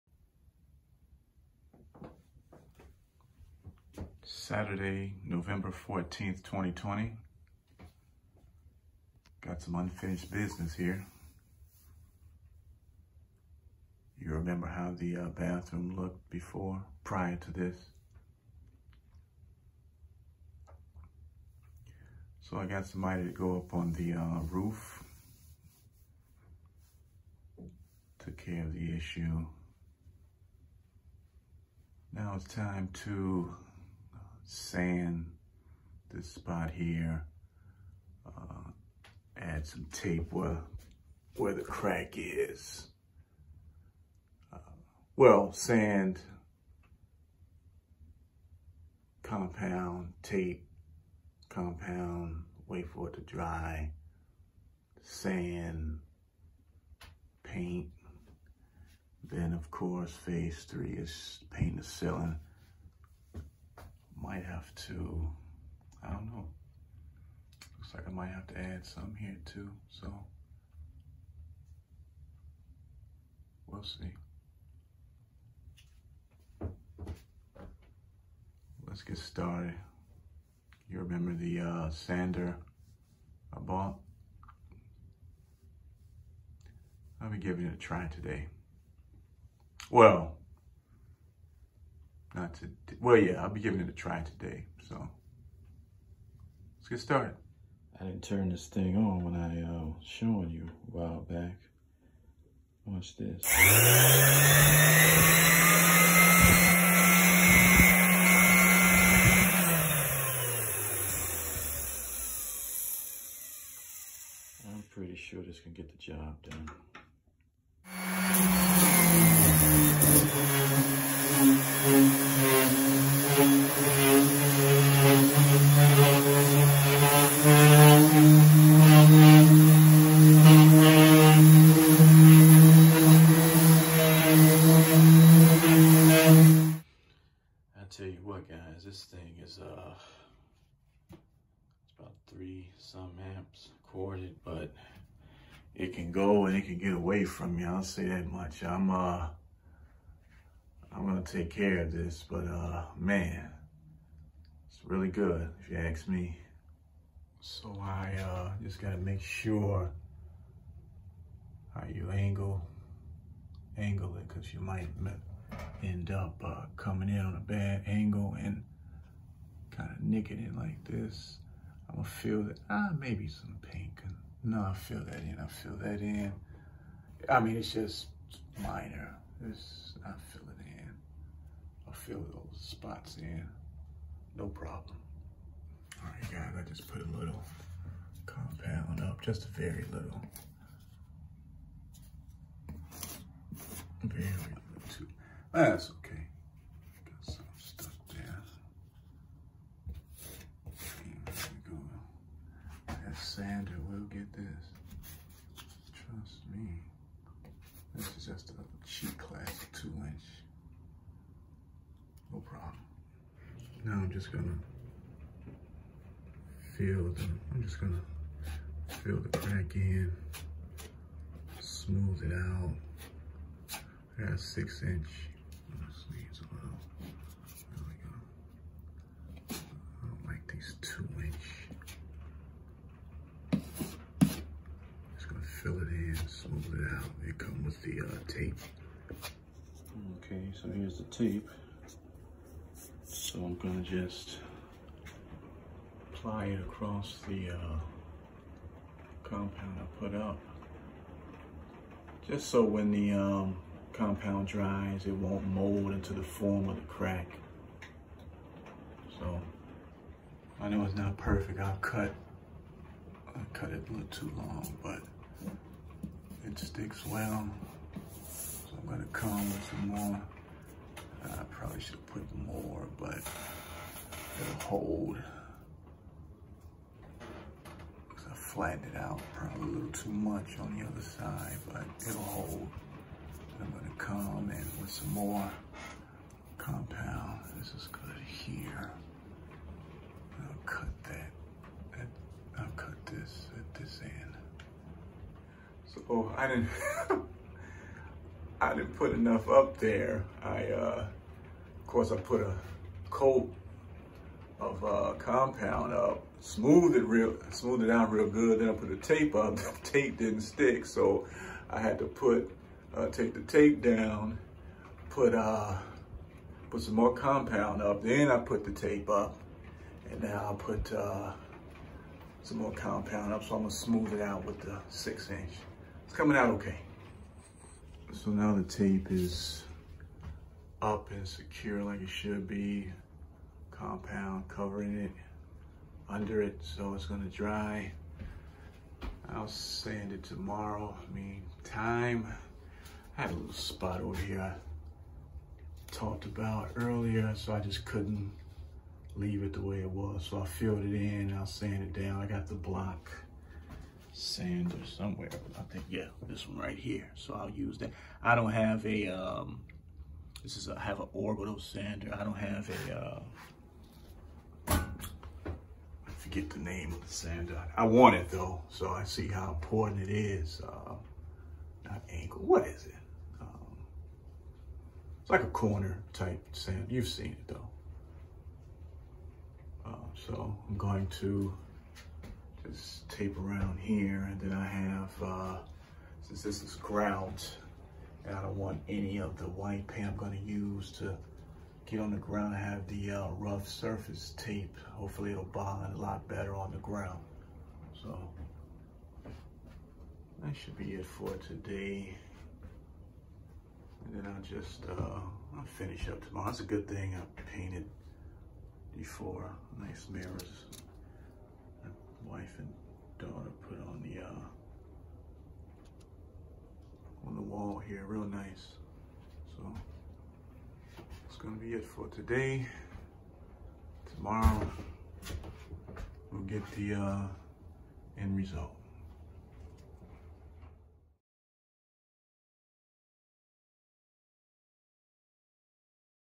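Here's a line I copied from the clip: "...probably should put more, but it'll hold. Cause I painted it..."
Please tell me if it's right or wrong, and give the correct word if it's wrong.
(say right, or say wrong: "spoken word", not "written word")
wrong: "flattened", not "painted".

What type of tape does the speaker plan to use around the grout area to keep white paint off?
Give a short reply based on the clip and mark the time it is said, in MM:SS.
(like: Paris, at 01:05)
rough surface tape, at 06:33.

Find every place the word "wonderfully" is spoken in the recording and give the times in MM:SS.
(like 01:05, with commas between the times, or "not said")
not said.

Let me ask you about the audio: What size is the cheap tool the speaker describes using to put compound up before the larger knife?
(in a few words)
2 inch.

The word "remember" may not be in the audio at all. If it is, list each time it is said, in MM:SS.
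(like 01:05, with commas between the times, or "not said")
00:14, 01:20.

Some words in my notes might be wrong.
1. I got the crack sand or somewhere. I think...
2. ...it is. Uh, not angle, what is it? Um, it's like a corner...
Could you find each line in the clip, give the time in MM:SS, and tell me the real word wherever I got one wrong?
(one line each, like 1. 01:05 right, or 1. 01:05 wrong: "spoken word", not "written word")
1. 05:52 wrong: "block", not "crack"
2. 06:10 right.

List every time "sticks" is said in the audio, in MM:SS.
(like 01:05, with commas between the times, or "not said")
04:26, 05:10.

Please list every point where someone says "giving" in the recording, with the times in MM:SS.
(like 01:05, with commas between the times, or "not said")
01:27, 01:33.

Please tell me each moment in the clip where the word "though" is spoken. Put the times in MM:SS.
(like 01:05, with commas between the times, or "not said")
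06:08, 06:17.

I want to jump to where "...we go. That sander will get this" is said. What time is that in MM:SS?
03:21.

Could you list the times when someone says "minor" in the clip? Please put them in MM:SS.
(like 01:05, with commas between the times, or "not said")
02:58.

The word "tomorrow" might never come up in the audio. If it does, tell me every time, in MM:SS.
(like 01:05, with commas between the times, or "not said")
05:40, 06:46, 07:04.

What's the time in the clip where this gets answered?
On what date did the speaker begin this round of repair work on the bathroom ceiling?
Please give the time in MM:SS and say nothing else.
00:05.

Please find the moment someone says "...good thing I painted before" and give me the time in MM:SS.
06:46.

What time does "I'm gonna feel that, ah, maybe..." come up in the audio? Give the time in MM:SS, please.
02:51.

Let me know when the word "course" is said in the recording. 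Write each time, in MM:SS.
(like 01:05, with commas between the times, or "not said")
00:59, 05:01.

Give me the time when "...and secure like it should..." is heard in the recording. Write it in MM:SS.
05:31.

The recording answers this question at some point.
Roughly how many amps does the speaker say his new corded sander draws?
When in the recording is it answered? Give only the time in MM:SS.
02:22.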